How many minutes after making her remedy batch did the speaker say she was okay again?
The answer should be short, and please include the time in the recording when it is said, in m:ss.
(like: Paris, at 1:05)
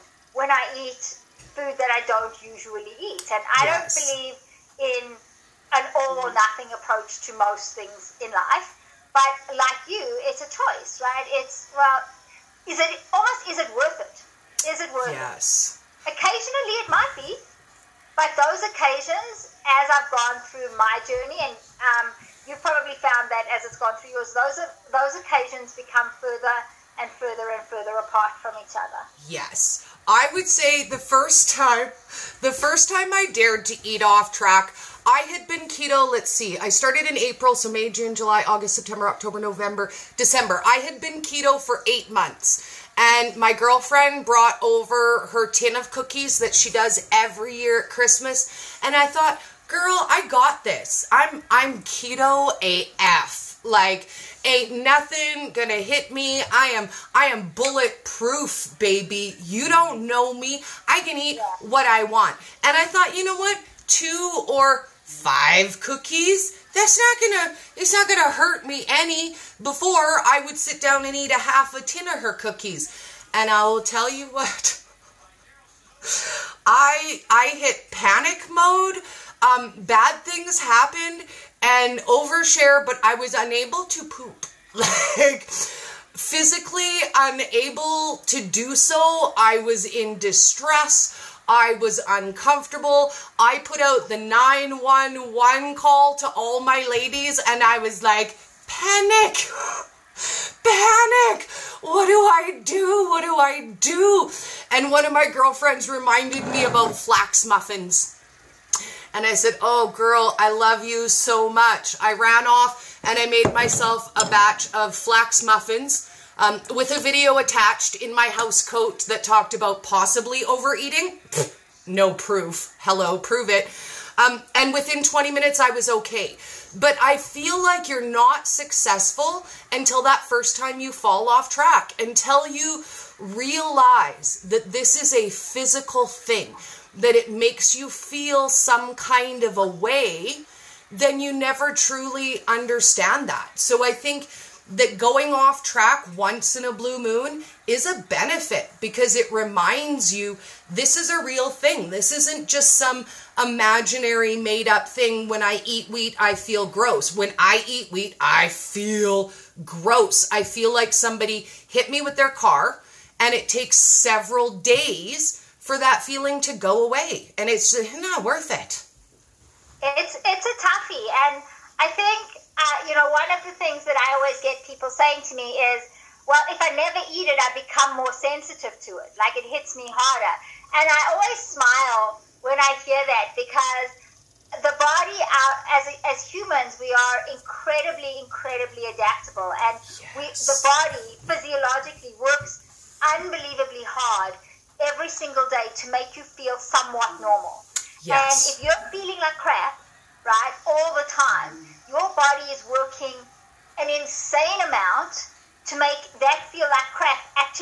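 20, at 2:05.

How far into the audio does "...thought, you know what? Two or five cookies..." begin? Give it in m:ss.
1:02.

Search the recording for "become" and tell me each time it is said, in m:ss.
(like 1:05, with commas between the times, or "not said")
0:25, 2:57.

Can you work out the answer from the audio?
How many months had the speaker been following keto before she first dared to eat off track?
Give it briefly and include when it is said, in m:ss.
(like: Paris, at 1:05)
8, at 0:41.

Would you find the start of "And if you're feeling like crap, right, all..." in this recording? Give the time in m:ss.
3:18.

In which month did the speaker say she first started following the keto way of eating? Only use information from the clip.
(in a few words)
April.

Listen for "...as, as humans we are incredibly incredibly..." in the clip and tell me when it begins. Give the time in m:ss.
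3:05.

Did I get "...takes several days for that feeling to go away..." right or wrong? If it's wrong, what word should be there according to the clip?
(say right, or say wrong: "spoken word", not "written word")
right.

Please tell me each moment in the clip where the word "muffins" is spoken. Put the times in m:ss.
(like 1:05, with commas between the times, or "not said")
1:47, 1:55.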